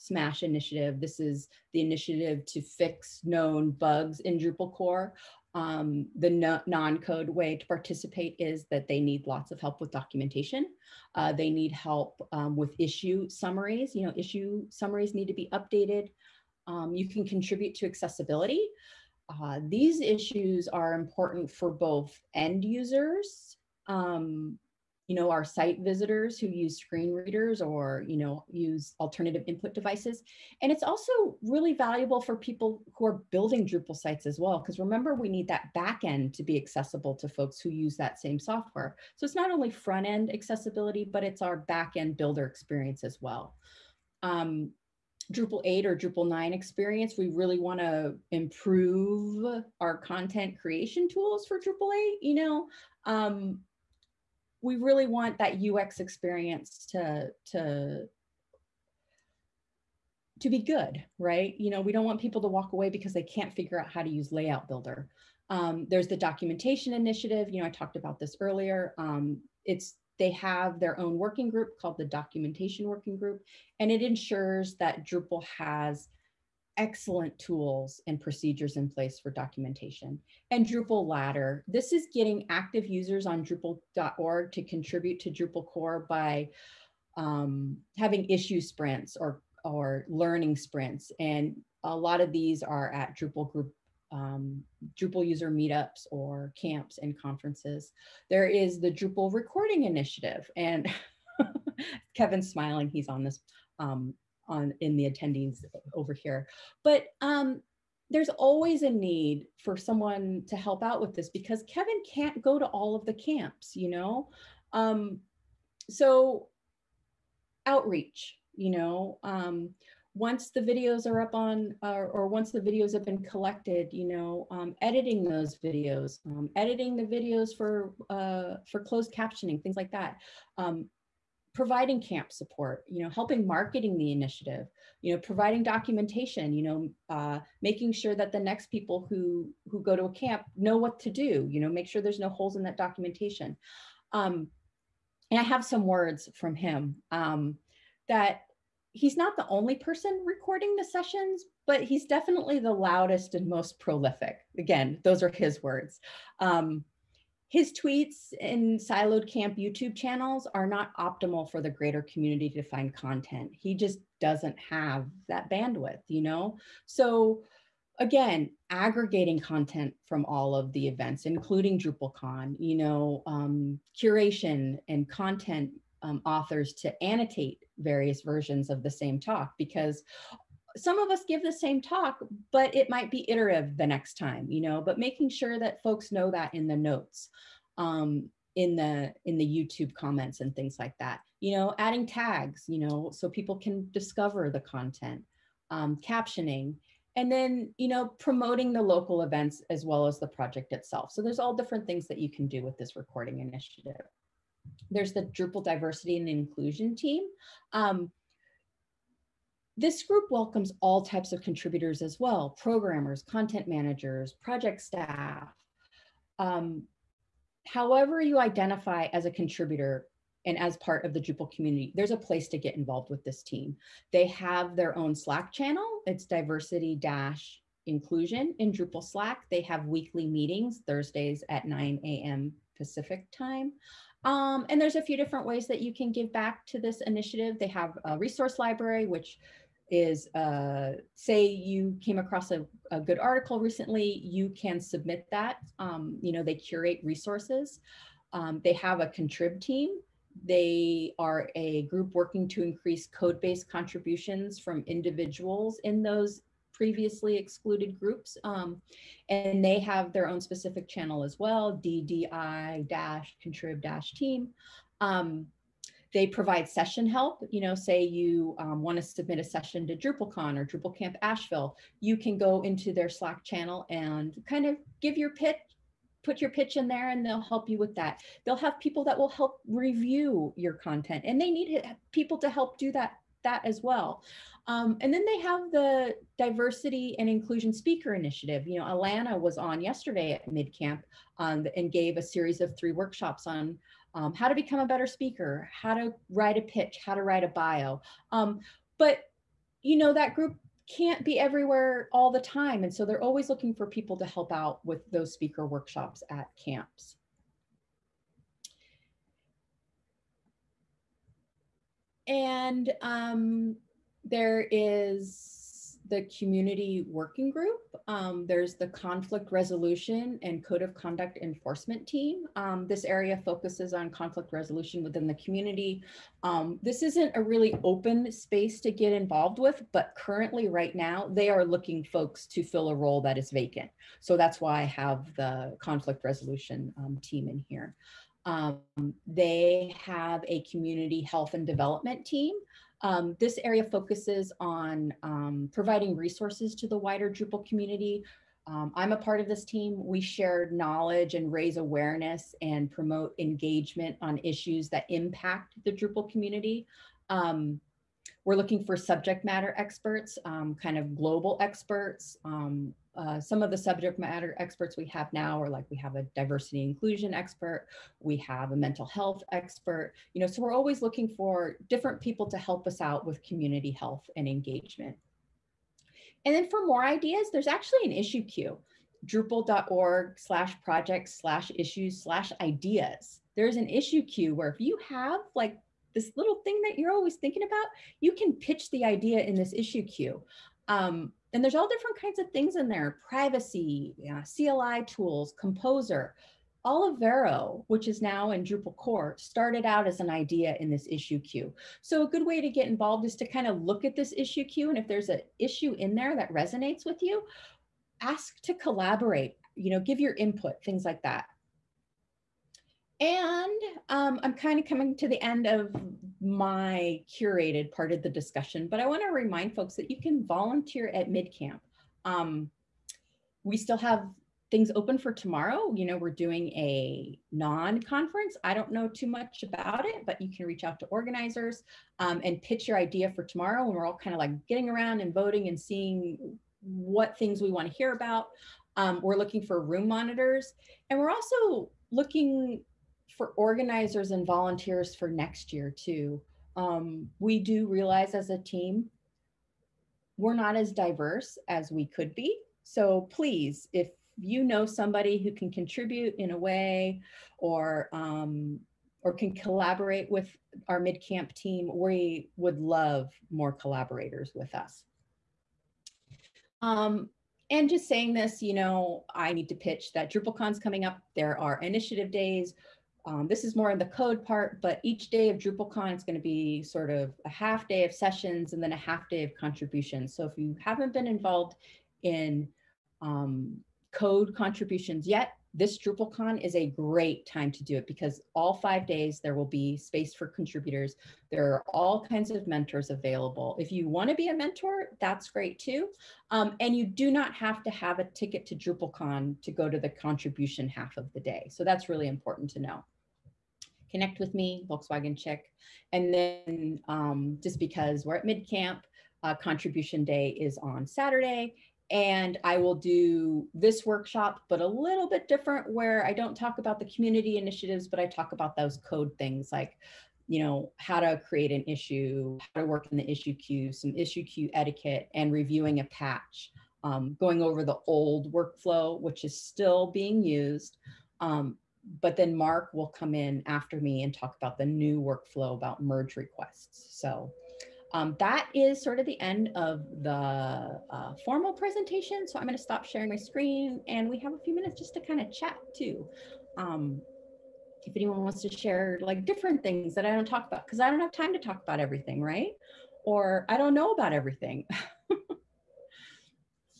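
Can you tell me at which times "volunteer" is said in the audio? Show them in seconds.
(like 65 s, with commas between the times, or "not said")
420 s, 444 s.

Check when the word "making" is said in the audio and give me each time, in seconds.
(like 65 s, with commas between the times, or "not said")
137 s, 184 s.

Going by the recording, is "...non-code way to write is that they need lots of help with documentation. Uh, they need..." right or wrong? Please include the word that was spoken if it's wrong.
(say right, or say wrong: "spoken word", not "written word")
wrong: "participate", not "write".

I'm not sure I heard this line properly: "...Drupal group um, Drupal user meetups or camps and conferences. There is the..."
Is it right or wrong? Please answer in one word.
right.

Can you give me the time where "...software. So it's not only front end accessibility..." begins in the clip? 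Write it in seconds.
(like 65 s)
38 s.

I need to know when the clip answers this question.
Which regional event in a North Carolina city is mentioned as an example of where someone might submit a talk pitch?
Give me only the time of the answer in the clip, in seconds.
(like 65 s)
270 s.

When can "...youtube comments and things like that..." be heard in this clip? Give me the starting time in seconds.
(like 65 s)
189 s.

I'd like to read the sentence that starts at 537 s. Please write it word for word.
So um, that is sort of the end of the uh, formal presentation.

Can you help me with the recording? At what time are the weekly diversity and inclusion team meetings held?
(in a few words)
9 a.m. Pacific.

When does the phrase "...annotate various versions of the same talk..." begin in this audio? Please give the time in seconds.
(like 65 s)
177 s.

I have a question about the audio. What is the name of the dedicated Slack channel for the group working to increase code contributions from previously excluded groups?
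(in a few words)
DDI-contrib-team.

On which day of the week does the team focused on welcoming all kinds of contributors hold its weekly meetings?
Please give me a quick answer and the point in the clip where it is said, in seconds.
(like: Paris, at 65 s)
Thursdays, at 230 s.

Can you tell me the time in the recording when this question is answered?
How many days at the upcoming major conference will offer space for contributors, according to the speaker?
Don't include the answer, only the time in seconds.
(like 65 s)
488 s.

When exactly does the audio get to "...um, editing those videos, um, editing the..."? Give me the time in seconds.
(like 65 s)
124 s.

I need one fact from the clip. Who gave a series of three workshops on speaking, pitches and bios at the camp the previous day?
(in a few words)
Alana.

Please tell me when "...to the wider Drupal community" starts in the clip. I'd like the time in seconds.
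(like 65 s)
346 s.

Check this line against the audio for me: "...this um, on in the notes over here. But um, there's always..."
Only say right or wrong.
wrong.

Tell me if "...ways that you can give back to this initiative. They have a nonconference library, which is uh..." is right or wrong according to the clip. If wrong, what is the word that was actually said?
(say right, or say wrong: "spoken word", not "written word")
wrong: "resource", not "nonconference".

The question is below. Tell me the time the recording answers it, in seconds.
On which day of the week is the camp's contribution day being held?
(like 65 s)
511 s.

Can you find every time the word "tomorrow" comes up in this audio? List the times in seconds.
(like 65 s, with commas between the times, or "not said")
425 s, 433 s.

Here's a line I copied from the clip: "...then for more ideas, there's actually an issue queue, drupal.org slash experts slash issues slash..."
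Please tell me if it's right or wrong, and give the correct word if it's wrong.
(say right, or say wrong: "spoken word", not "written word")
wrong: "projects", not "experts".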